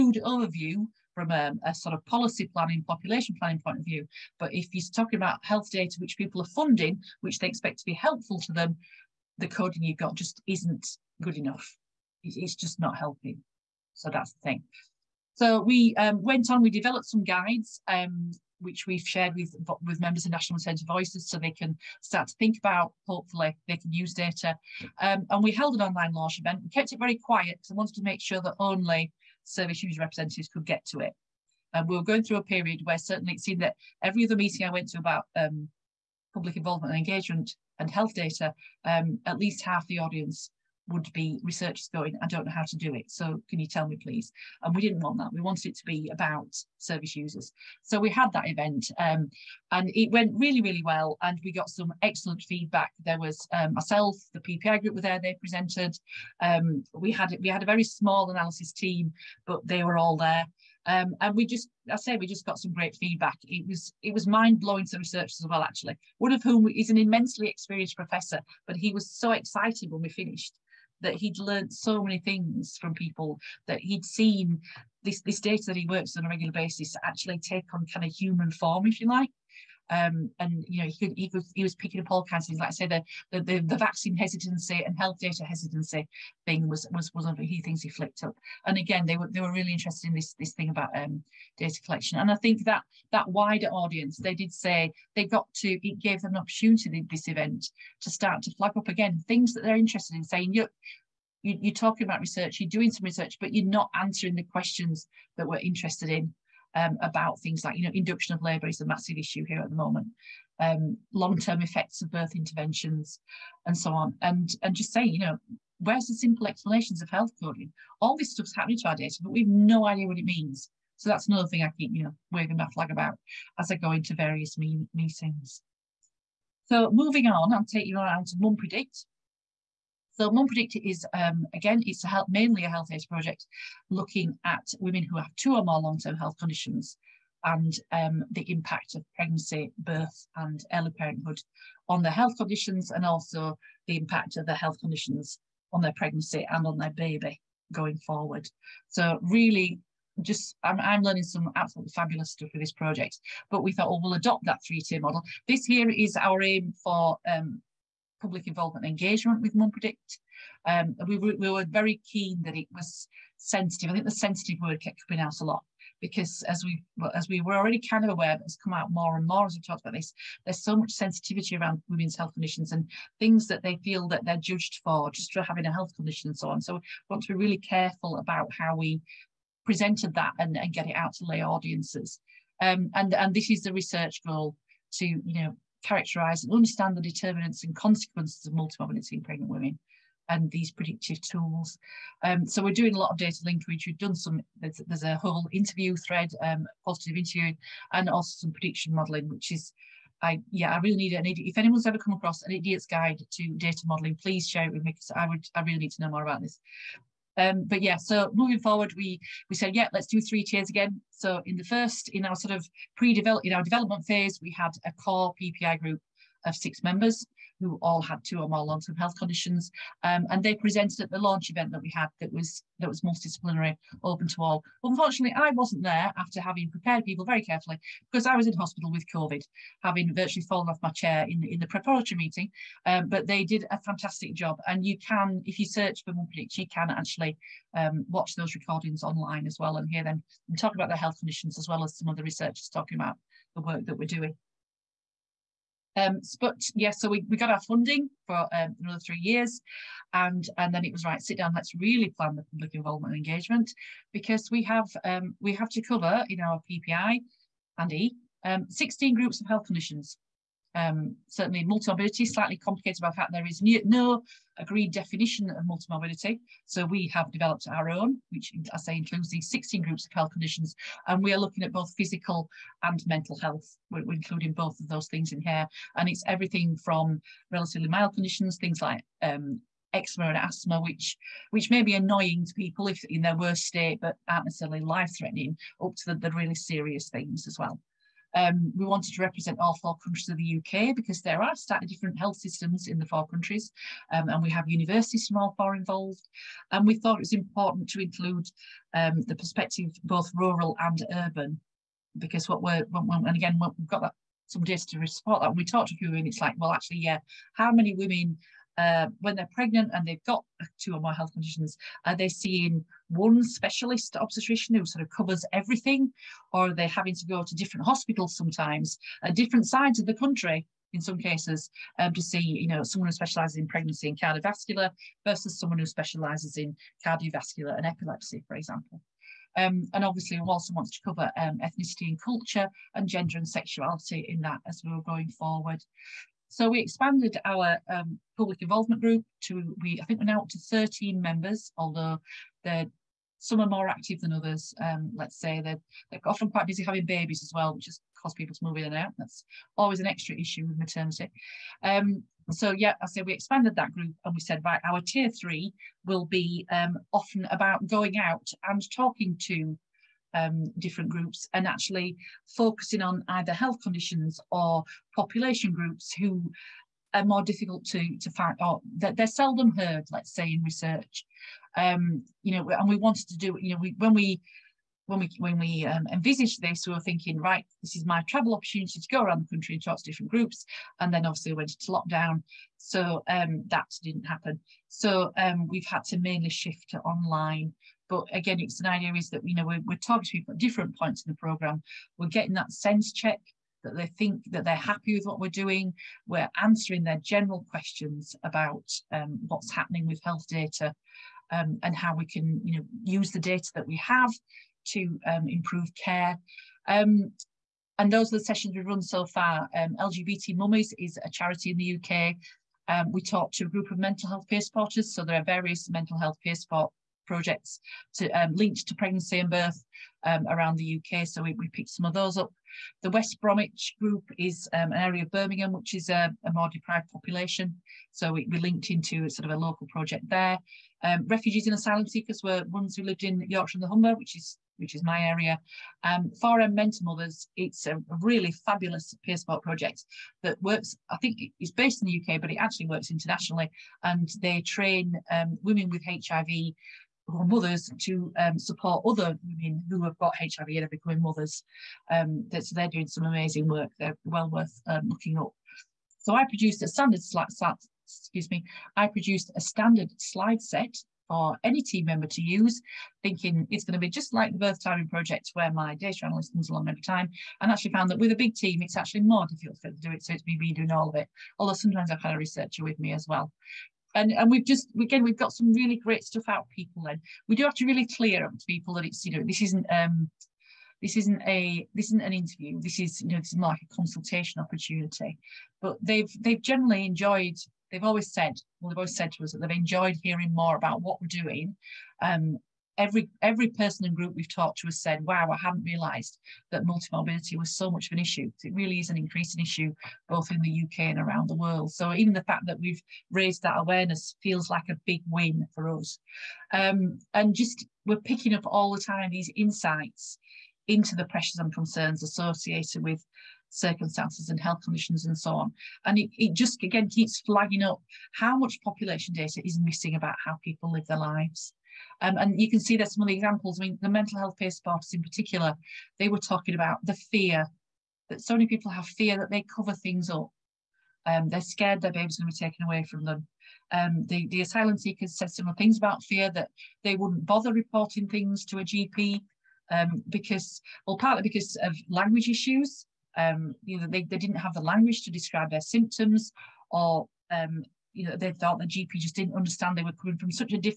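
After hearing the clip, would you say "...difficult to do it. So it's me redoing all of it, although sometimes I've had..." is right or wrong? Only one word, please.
right.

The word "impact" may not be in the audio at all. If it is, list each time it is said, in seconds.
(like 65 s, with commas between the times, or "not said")
138 s, 143 s.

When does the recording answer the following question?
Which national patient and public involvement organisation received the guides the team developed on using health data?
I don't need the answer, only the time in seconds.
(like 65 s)
20 s.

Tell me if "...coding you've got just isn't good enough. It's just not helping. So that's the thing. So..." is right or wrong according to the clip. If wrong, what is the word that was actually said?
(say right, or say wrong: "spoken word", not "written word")
right.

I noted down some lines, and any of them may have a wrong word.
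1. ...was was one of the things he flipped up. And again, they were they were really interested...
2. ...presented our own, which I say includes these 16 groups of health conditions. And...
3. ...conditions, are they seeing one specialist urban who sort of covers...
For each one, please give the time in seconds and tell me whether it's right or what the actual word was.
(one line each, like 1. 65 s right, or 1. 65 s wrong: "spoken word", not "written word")
1. 86 s right
2. 267 s wrong: "developed", not "presented"
3. 311 s wrong: "obstetrician", not "urban".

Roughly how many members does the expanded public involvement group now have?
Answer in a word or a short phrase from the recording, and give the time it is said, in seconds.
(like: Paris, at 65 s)
13, at 340 s.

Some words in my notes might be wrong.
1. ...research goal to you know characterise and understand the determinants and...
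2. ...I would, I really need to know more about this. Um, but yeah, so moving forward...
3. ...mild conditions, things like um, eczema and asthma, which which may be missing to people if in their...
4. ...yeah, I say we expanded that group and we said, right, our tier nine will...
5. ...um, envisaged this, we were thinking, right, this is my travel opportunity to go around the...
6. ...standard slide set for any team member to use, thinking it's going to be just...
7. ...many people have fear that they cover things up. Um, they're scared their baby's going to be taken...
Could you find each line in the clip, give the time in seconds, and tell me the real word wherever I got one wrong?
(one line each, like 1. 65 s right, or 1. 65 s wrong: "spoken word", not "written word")
1. 183 s right
2. 205 s right
3. 277 s wrong: "annoying", not "missing"
4. 352 s wrong: "three", not "nine"
5. 375 s right
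6. 459 s right
7. 528 s right.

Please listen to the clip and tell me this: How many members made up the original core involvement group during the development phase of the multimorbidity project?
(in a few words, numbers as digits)
6.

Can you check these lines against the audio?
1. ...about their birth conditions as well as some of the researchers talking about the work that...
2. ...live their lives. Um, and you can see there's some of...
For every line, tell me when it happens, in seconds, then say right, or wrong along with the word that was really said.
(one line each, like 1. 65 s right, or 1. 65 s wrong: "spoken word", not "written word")
1. 240 s wrong: "health", not "birth"
2. 520 s right.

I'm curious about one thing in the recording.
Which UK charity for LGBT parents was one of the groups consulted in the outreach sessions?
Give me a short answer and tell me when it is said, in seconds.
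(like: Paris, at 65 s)
LGBT Mummies, at 409 s.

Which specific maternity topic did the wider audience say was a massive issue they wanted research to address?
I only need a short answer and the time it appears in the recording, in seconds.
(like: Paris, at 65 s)
Induction of labour, at 107 s.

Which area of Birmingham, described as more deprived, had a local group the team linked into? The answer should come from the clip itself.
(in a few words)
West Bromwich.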